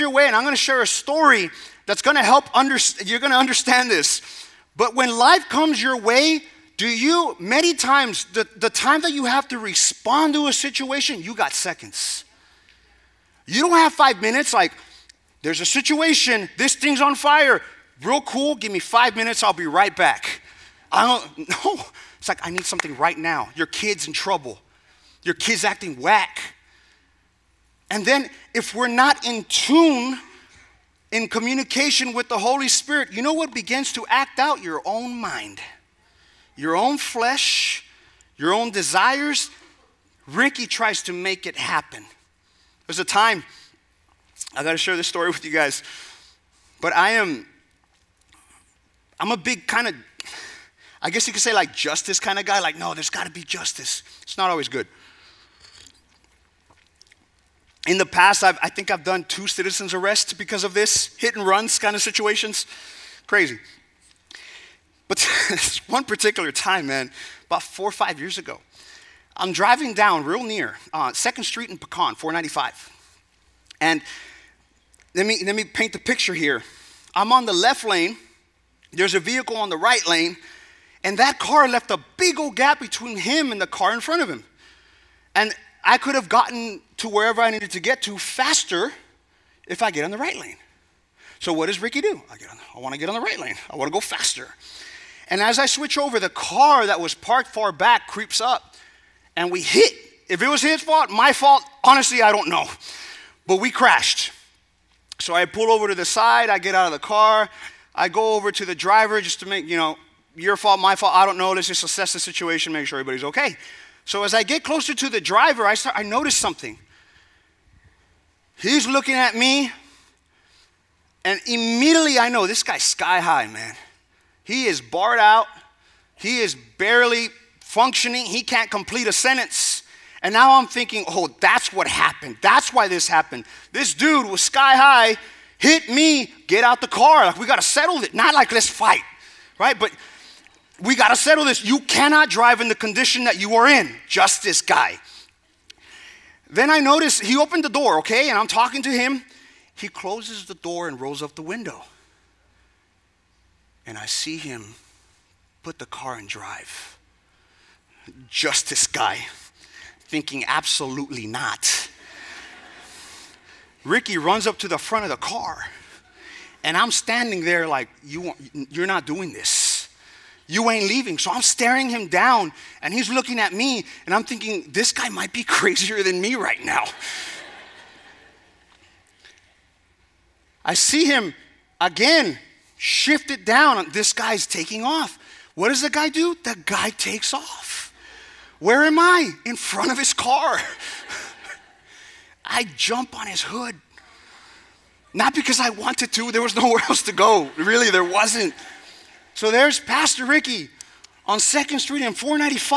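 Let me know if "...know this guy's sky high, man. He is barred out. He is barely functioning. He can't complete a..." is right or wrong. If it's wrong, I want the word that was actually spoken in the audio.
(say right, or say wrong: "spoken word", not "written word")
right.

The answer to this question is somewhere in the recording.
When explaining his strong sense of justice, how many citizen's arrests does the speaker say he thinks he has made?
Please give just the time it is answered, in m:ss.
0:59.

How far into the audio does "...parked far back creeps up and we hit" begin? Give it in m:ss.
1:37.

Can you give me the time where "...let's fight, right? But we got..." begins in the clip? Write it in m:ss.
2:18.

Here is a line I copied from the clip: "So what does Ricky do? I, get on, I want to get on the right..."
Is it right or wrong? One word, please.
right.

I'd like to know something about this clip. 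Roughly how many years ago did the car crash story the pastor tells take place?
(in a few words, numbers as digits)
4 or 5 years.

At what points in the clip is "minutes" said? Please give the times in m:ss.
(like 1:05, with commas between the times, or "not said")
0:14, 0:19.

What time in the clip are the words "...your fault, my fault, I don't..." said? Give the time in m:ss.
1:50.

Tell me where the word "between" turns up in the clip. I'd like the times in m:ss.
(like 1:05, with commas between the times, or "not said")
1:22.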